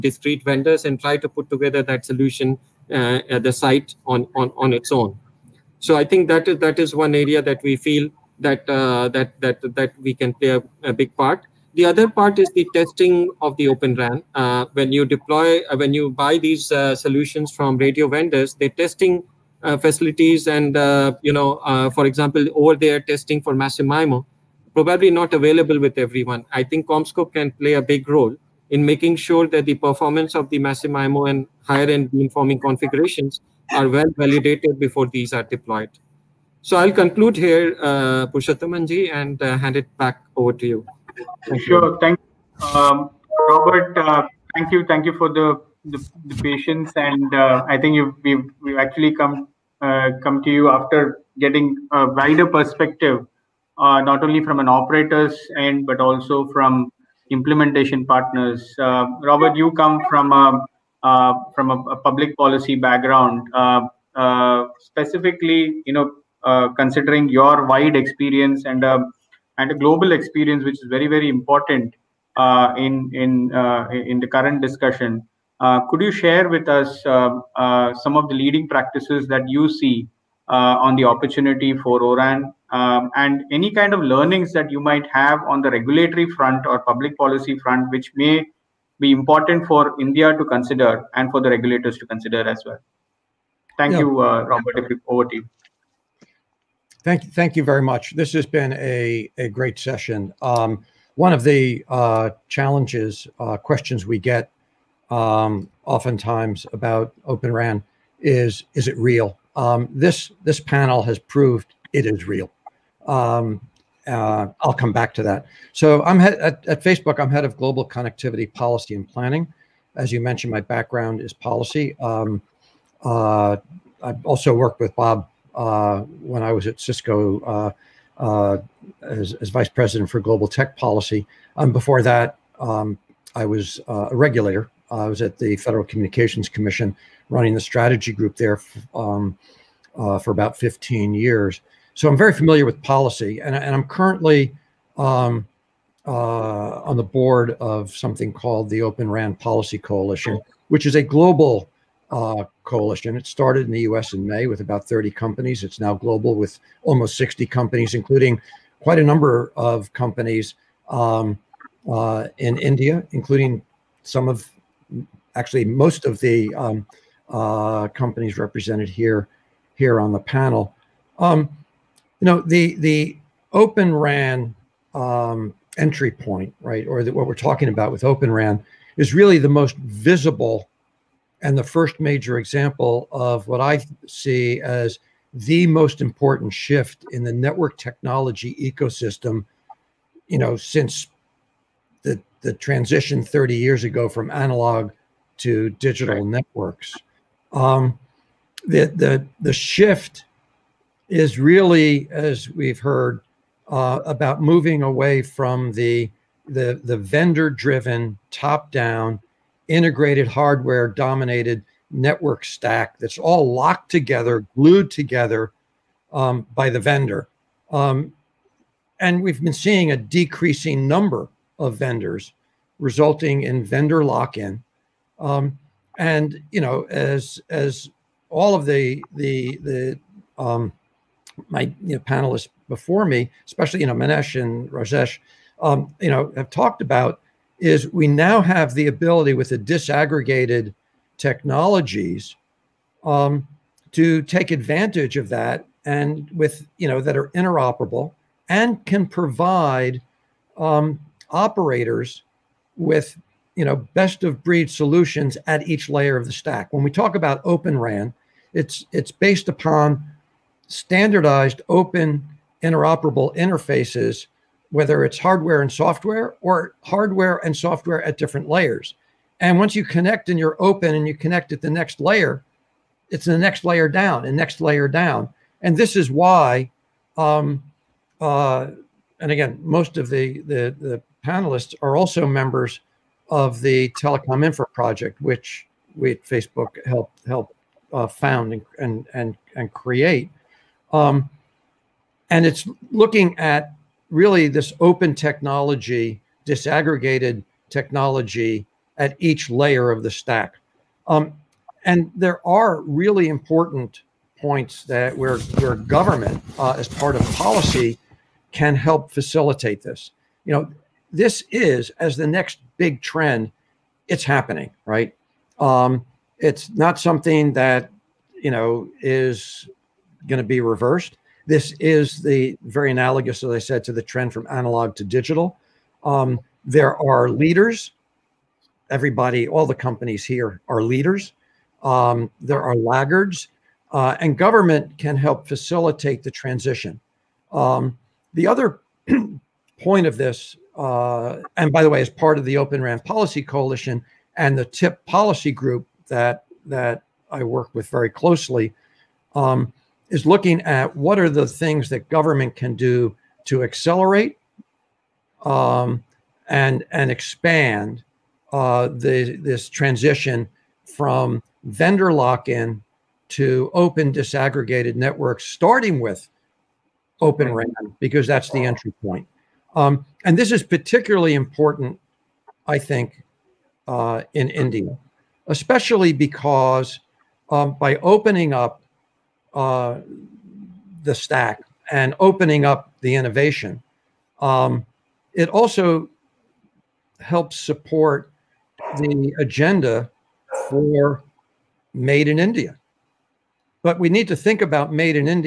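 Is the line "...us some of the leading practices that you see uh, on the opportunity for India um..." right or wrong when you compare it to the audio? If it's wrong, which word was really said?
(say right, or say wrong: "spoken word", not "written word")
wrong: "ORAN", not "India".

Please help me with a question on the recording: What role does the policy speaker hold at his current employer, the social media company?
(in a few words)
Head of global connectivity policy and planning.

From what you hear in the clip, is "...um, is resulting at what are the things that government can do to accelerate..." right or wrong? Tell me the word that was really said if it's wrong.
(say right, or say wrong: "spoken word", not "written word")
wrong: "looking", not "resulting".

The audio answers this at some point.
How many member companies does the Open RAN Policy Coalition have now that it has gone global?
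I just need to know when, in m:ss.
2:36.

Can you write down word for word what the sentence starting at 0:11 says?
The other part is the testing of the Open RAN.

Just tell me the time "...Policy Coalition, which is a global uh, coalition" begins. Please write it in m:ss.
2:29.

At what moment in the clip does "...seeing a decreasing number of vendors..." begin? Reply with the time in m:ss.
3:39.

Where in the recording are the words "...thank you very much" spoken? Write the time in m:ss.
1:37.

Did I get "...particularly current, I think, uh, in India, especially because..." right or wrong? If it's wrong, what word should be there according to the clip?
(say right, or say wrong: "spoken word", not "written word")
wrong: "important", not "current".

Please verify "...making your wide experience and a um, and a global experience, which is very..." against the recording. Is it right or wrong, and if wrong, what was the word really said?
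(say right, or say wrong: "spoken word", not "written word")
wrong: "considering", not "making".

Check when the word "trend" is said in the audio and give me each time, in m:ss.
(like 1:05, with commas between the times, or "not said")
5:13, 5:24.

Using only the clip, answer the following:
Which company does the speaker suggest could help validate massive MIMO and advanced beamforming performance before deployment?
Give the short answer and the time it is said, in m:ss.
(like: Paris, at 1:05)
CommScope, at 0:26.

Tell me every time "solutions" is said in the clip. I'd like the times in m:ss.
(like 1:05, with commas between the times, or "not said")
0:02, 0:16, 4:14.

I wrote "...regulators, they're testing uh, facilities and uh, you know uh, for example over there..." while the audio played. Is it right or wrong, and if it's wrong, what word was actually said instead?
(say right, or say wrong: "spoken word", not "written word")
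wrong: "vendors", not "regulators".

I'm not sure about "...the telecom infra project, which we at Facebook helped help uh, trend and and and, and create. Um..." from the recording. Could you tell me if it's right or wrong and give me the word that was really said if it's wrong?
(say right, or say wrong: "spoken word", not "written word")
wrong: "found", not "trend".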